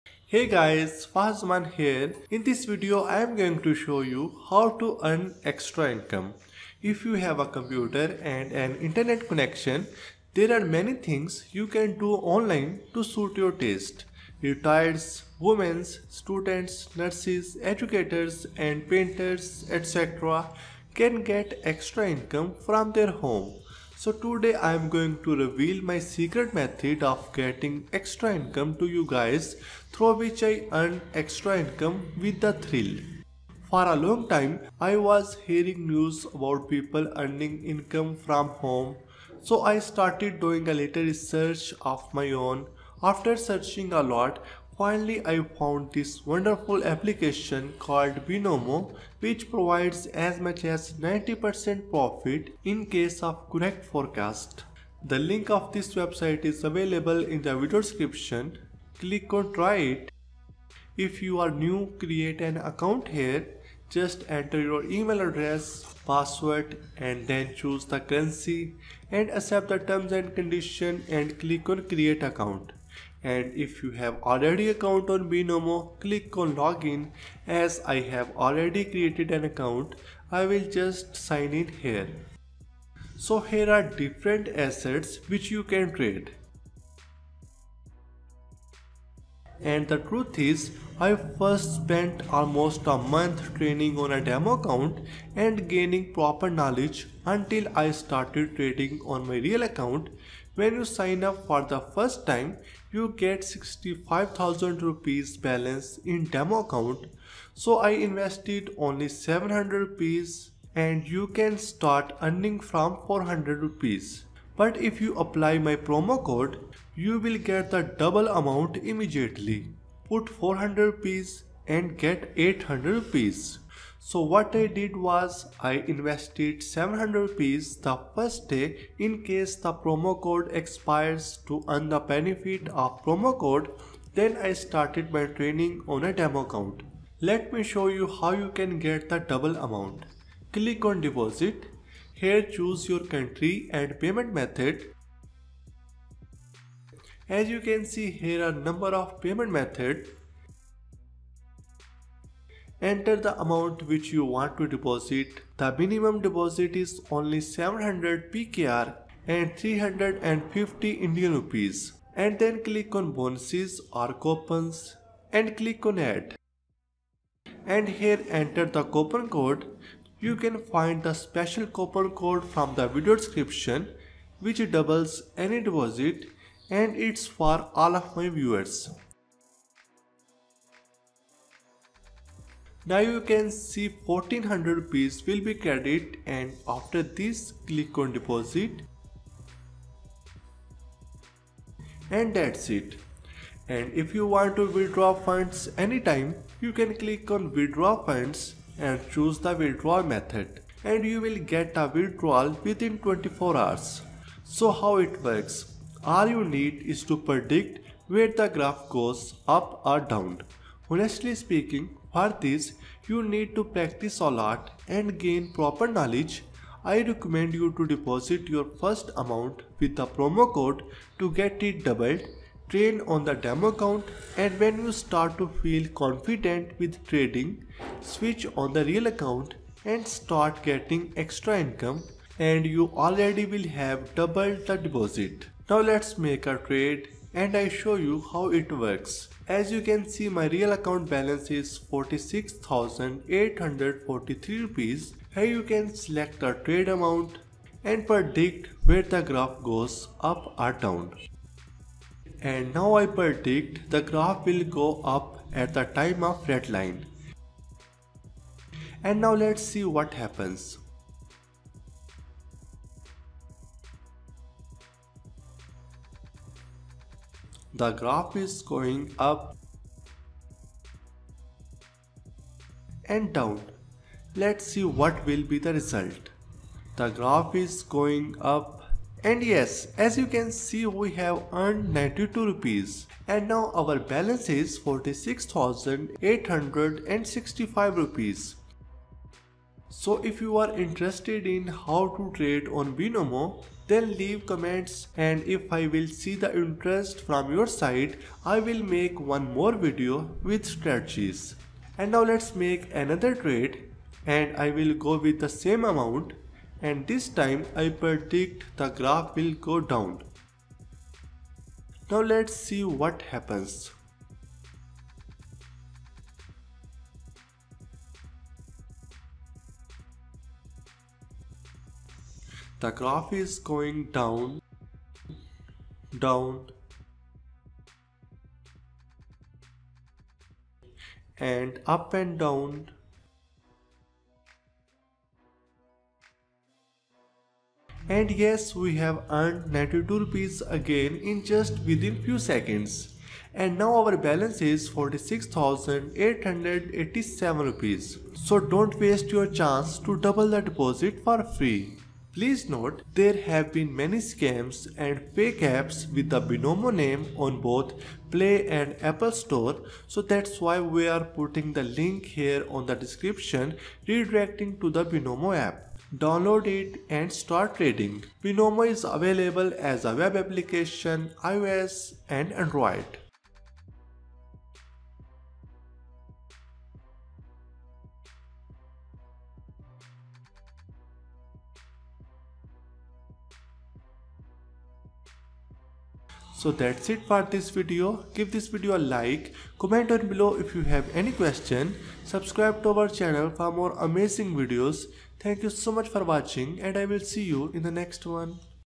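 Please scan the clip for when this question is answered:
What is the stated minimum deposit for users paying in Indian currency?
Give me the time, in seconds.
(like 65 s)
159 s.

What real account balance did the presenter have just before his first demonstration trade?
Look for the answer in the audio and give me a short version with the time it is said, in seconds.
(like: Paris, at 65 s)
46,843 rupees, at 241 s.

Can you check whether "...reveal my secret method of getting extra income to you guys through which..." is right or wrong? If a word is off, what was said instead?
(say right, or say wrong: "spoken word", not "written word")
right.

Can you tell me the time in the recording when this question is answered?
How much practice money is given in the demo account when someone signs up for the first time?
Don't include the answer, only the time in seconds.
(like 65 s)
103 s.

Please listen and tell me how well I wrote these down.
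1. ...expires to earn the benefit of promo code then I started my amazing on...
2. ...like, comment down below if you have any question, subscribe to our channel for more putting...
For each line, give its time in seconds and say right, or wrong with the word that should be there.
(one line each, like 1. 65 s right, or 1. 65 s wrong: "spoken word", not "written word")
1. 130 s wrong: "training", not "amazing"
2. 388 s wrong: "amazing", not "putting".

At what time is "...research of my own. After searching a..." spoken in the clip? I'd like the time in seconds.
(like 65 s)
41 s.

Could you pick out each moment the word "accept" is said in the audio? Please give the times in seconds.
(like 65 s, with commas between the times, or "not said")
69 s.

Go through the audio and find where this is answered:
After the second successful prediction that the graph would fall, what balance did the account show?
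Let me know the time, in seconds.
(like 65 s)
344 s.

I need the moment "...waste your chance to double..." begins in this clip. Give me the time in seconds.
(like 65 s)
348 s.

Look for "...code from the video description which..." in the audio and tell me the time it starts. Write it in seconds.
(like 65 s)
172 s.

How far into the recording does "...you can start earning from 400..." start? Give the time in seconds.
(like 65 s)
111 s.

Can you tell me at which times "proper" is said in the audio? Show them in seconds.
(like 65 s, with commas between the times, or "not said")
96 s, 215 s.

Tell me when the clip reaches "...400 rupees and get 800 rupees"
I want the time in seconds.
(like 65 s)
120 s.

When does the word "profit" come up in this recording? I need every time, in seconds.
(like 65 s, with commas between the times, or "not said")
51 s.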